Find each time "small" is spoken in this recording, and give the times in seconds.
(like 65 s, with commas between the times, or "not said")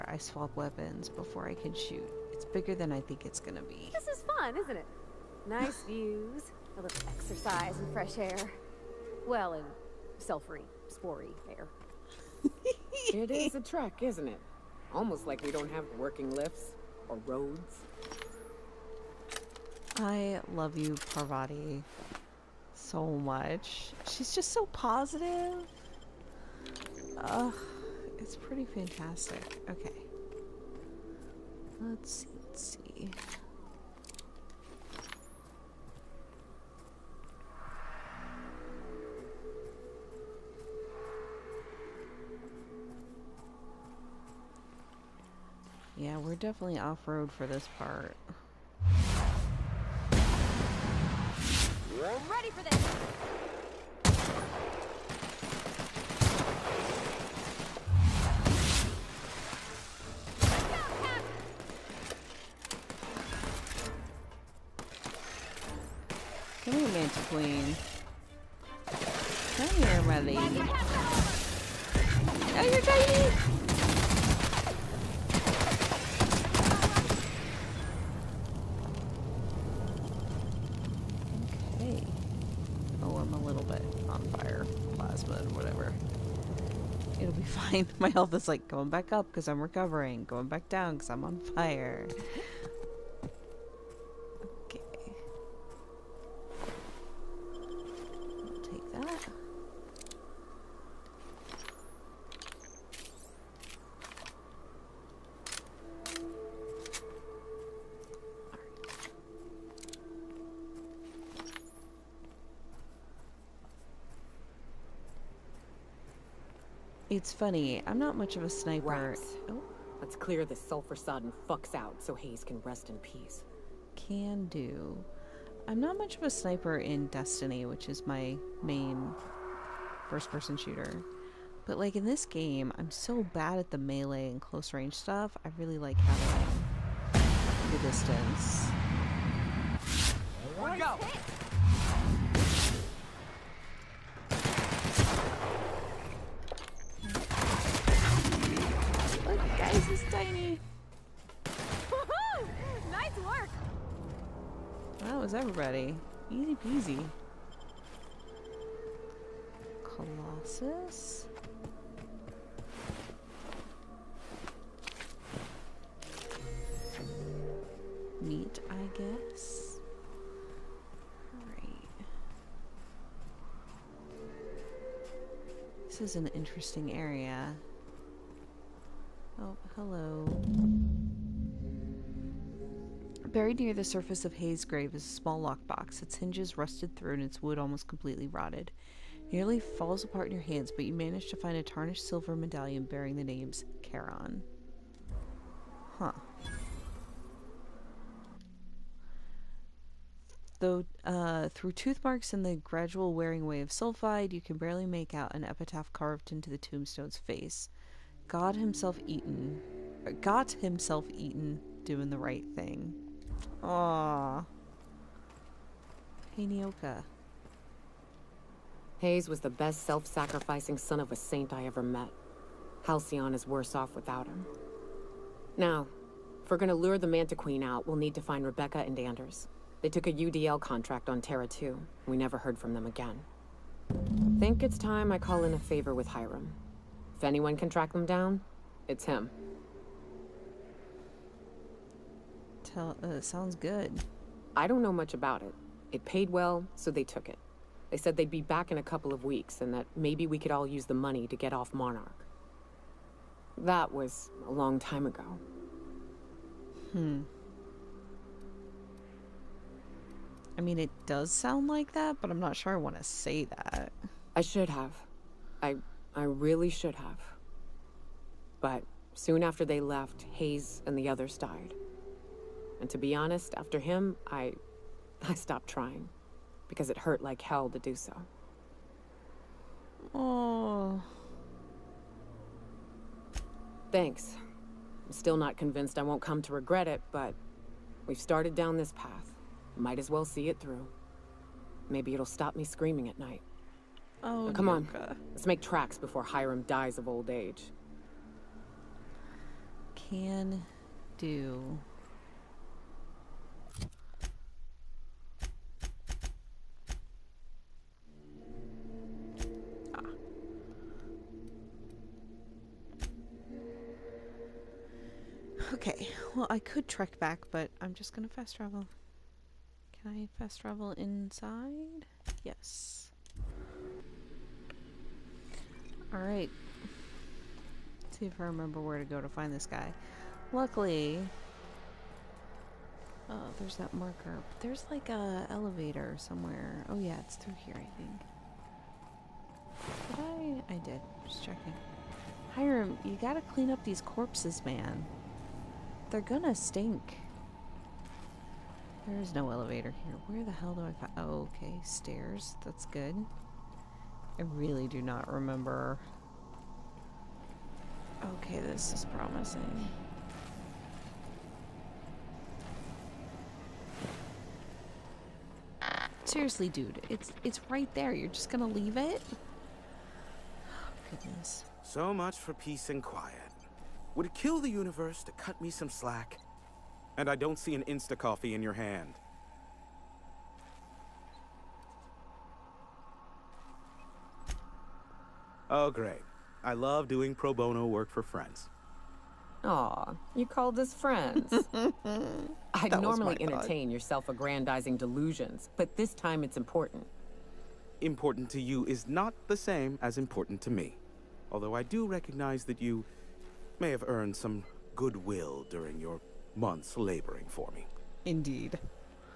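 185 s.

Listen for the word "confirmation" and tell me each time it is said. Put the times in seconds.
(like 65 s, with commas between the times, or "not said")
not said.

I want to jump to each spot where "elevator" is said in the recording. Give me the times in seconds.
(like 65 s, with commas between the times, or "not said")
335 s, 349 s.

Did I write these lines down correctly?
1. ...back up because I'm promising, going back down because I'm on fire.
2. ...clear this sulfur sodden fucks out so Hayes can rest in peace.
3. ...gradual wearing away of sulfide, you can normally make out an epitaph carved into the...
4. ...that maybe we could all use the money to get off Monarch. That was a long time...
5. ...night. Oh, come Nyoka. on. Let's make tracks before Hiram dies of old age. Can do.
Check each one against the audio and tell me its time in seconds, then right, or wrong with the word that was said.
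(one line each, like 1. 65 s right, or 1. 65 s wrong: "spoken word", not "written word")
1. 88 s wrong: "recovering", not "promising"
2. 120 s right
3. 202 s wrong: "barely", not "normally"
4. 249 s right
5. 293 s right.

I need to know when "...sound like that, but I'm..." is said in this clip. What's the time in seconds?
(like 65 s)
261 s.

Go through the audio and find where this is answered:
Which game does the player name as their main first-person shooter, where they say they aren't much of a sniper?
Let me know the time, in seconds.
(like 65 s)
127 s.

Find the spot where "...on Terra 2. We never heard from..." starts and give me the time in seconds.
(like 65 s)
231 s.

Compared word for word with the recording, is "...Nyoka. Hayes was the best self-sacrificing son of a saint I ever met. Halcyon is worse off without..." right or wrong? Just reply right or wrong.
right.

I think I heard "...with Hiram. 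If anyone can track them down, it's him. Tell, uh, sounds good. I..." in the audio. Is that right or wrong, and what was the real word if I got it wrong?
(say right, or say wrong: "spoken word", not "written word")
right.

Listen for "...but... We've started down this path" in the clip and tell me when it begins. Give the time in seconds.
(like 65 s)
287 s.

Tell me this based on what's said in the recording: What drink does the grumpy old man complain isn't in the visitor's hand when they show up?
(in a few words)
Insta coffee.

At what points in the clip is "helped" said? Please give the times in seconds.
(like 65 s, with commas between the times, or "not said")
not said.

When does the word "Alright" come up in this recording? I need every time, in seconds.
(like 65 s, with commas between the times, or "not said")
326 s.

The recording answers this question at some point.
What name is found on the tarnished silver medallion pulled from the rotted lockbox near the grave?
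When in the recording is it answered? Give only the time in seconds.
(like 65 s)
193 s.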